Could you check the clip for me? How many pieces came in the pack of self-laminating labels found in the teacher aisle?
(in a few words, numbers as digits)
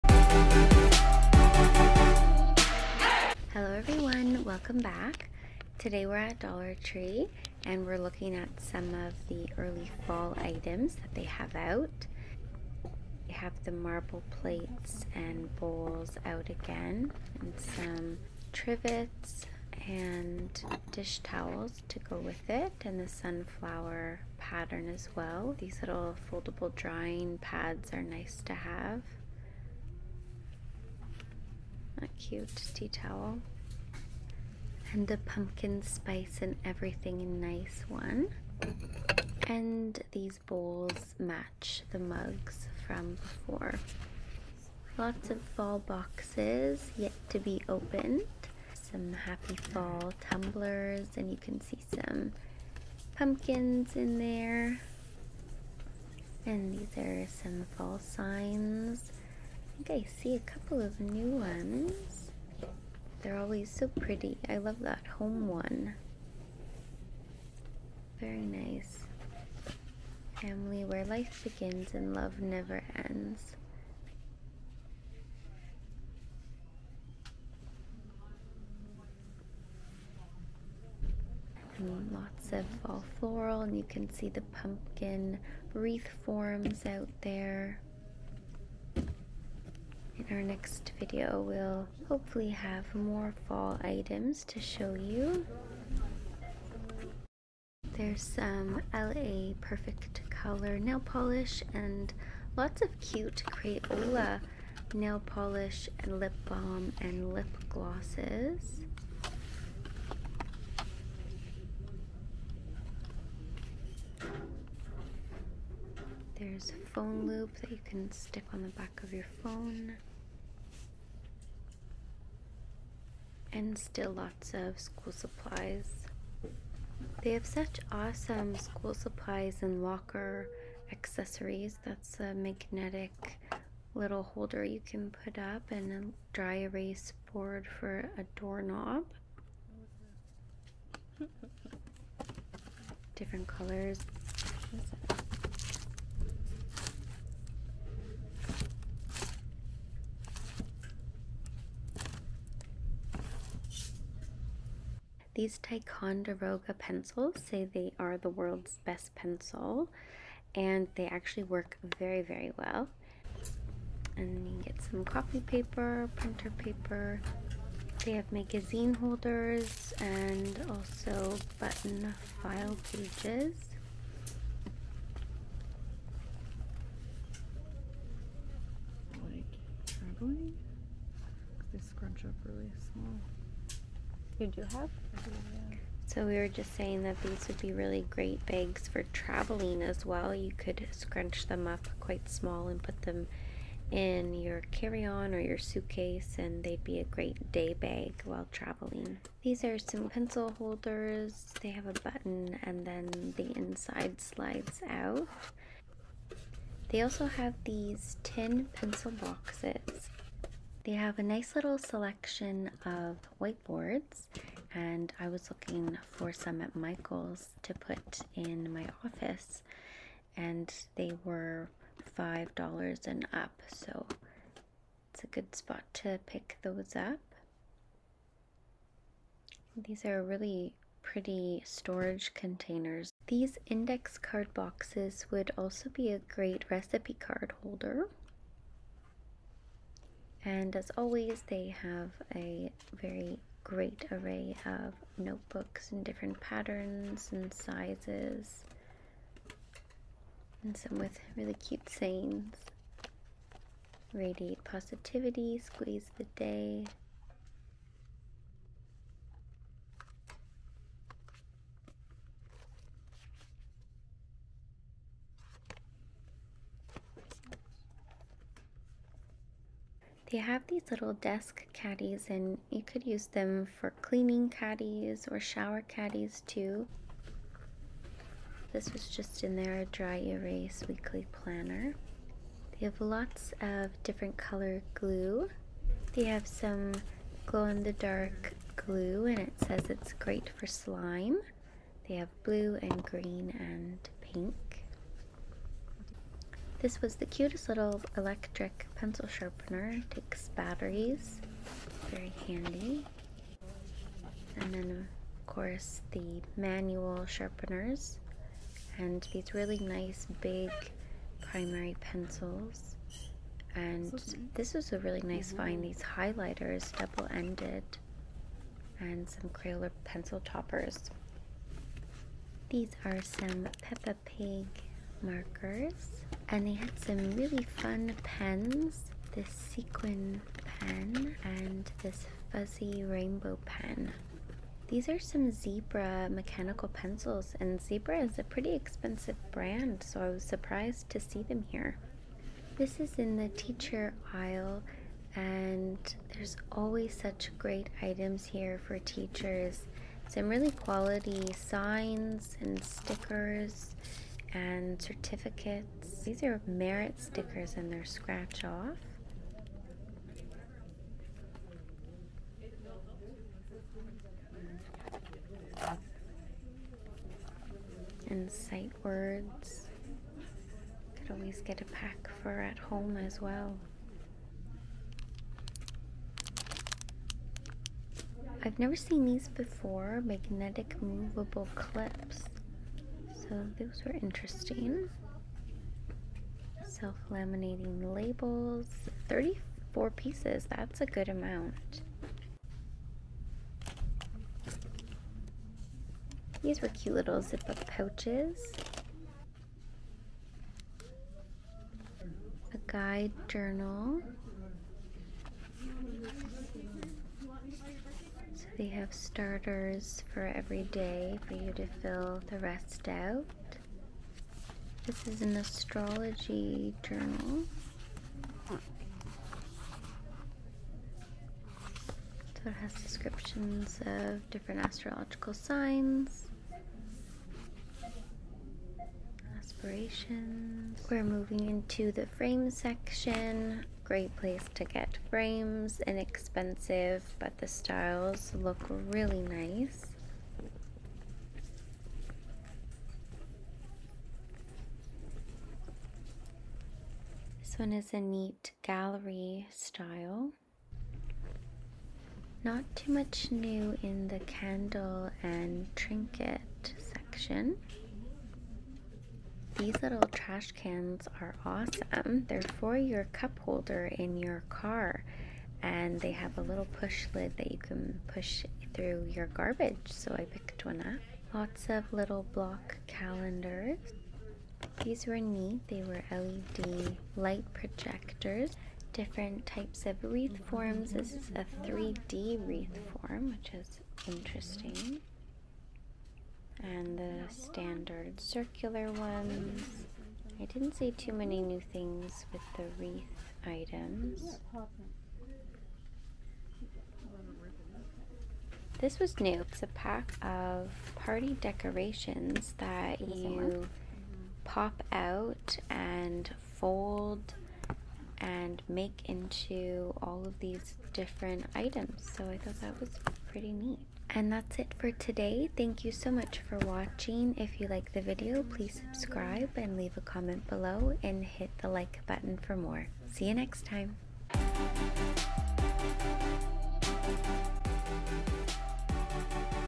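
34.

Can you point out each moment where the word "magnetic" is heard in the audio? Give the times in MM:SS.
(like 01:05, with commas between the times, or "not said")
02:12, 06:20.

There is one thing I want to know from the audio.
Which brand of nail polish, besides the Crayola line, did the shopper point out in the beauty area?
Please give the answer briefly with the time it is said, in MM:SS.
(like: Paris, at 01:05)
LA Perfect Color, at 01:38.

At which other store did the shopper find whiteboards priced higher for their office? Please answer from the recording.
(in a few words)
Michael's.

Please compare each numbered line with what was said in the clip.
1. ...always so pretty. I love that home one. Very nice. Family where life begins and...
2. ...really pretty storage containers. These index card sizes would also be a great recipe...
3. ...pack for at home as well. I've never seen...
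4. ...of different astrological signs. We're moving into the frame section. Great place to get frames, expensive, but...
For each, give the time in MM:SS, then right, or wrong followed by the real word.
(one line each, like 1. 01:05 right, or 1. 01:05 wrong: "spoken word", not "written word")
1. 01:03 right
2. 03:50 wrong: "boxes", not "sizes"
3. 06:11 right
4. 07:04 wrong: "inexpensive", not "expensive".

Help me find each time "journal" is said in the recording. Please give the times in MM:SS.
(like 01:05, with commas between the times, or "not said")
06:43, 06:57.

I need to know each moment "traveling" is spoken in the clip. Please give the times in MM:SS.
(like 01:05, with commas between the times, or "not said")
02:59, 03:09, 03:18.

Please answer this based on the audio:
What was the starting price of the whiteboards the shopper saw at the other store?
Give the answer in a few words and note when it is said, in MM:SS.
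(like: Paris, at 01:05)
$5, at 03:42.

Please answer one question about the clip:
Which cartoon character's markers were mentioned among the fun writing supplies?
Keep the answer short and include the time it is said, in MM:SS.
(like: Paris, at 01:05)
Peppa Pig, at 05:23.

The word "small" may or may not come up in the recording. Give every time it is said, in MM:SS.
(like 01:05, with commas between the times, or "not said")
03:02, 03:12.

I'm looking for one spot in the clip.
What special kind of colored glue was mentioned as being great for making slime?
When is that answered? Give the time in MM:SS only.
04:47.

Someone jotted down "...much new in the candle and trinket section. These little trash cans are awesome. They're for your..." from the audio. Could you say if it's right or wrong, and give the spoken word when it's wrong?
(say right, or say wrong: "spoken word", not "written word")
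right.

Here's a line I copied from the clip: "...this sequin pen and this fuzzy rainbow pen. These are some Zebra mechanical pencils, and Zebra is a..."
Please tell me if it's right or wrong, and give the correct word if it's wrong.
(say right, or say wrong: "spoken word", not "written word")
right.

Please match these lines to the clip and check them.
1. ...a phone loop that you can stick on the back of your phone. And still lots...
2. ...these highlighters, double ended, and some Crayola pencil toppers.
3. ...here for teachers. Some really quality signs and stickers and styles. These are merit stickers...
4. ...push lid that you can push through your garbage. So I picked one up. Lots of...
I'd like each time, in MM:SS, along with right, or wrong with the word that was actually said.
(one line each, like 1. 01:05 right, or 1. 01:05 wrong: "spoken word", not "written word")
1. 01:56 right
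2. 05:15 right
3. 05:48 wrong: "certificates", not "styles"
4. 07:46 right.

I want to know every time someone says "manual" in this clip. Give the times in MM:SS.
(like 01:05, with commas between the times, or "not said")
05:06.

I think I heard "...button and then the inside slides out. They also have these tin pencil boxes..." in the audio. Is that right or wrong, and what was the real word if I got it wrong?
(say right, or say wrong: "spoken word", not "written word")
right.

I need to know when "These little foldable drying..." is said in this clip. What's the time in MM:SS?
00:25.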